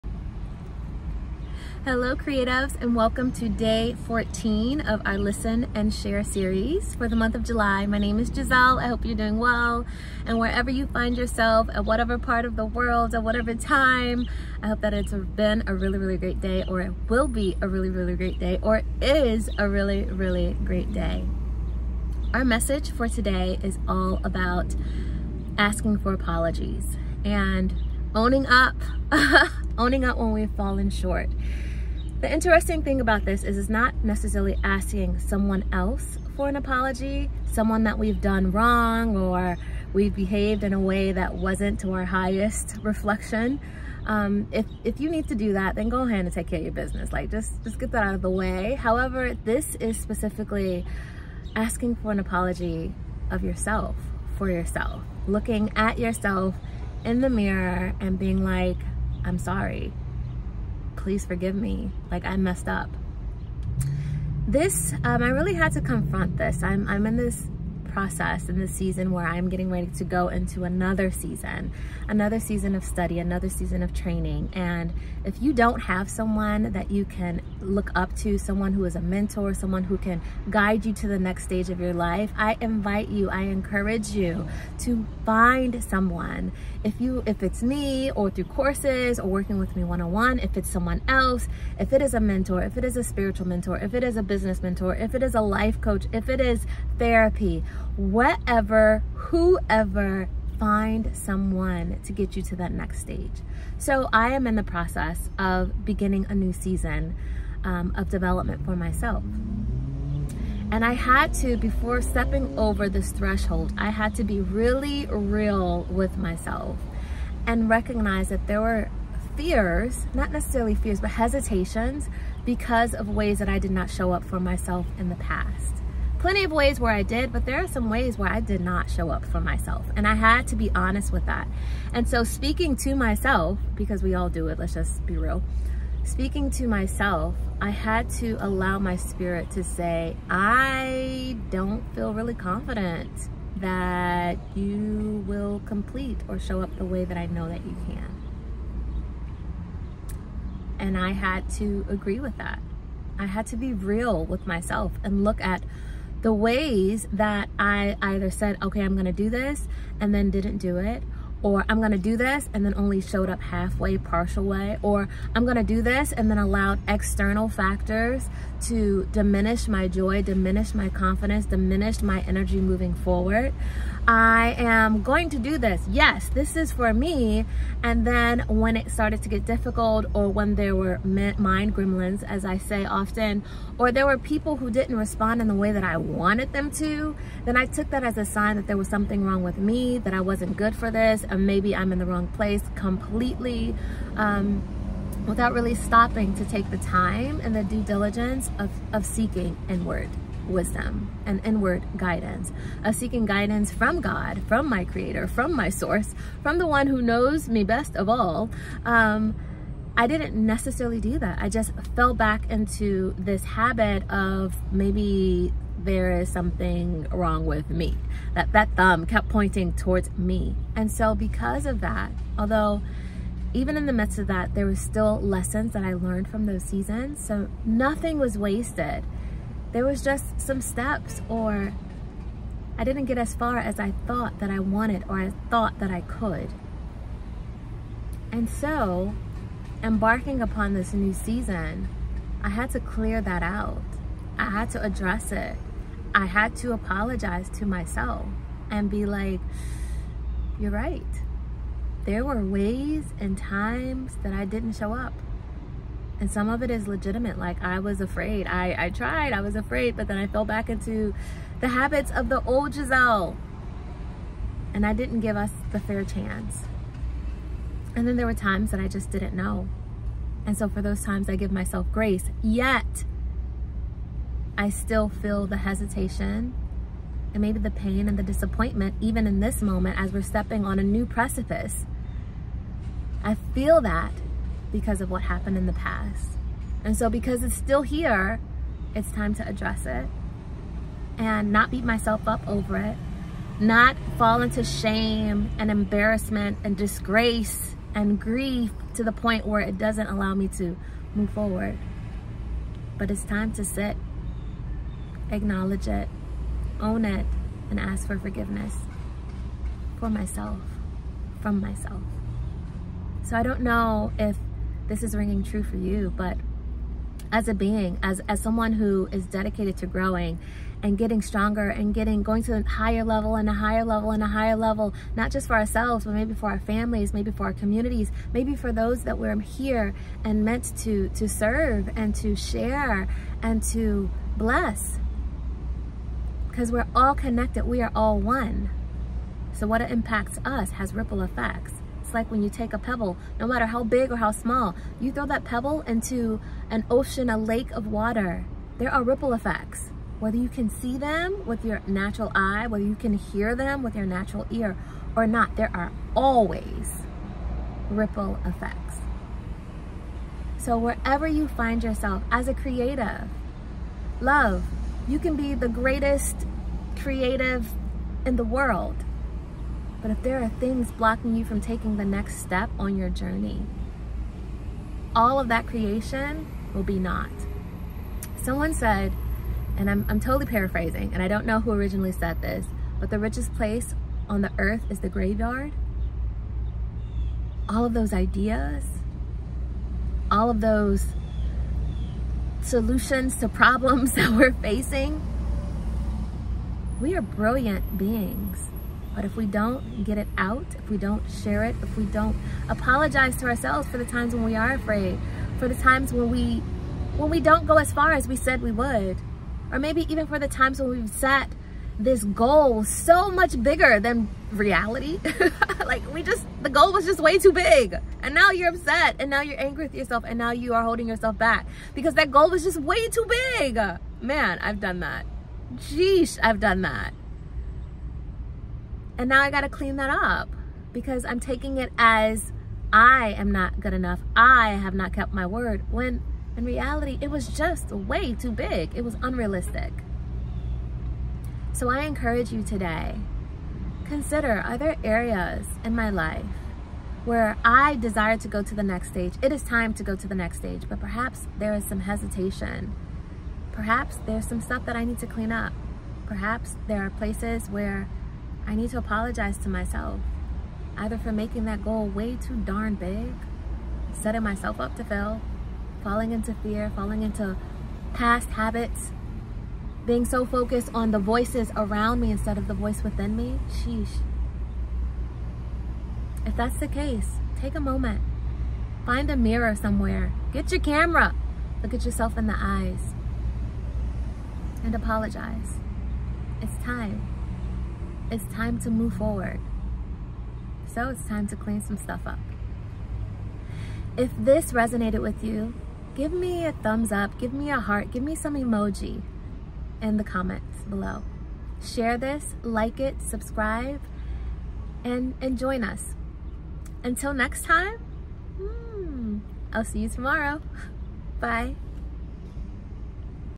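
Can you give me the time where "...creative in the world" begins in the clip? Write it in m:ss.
6:06.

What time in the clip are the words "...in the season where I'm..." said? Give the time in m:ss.
1:08.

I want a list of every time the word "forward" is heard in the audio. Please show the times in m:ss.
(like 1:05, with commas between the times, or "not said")
2:52, 5:01, 8:09.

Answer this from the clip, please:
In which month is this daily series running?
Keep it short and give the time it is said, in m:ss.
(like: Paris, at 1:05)
July, at 0:07.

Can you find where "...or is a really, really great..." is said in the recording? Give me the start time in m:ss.
0:18.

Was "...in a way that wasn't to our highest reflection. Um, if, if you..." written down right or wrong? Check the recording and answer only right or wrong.
right.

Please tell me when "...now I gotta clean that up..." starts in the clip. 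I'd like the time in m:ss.
7:09.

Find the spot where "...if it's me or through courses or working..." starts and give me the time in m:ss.
1:27.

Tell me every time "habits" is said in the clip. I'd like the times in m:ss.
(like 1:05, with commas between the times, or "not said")
3:33, 4:21, 7:48.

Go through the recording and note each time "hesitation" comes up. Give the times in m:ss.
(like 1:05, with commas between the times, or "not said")
2:01, 4:35, 7:32.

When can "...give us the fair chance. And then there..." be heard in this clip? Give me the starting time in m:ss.
4:25.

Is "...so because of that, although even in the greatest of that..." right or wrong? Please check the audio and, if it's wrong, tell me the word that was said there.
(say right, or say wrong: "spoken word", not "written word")
wrong: "midst", not "greatest".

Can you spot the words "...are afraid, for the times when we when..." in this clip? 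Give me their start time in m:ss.
6:44.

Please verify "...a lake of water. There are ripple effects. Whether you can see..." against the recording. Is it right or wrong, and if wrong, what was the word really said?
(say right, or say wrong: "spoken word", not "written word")
right.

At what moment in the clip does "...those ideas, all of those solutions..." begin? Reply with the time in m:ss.
6:27.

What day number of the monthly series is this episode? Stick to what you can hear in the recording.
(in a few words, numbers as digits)
14.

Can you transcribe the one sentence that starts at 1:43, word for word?
So I am in the process of beginning a new season um, of development for myself.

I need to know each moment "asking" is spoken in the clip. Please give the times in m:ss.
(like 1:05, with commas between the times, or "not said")
0:25, 0:34, 0:51.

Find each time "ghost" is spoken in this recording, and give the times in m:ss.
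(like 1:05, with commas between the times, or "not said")
not said.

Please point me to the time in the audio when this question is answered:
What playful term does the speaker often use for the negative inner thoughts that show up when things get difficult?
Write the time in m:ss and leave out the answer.
3:01.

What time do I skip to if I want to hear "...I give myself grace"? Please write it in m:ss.
4:31.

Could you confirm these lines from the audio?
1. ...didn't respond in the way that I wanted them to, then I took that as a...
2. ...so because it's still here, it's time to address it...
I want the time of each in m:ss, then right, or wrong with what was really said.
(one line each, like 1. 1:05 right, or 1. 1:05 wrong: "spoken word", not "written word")
1. 3:04 right
2. 4:46 right.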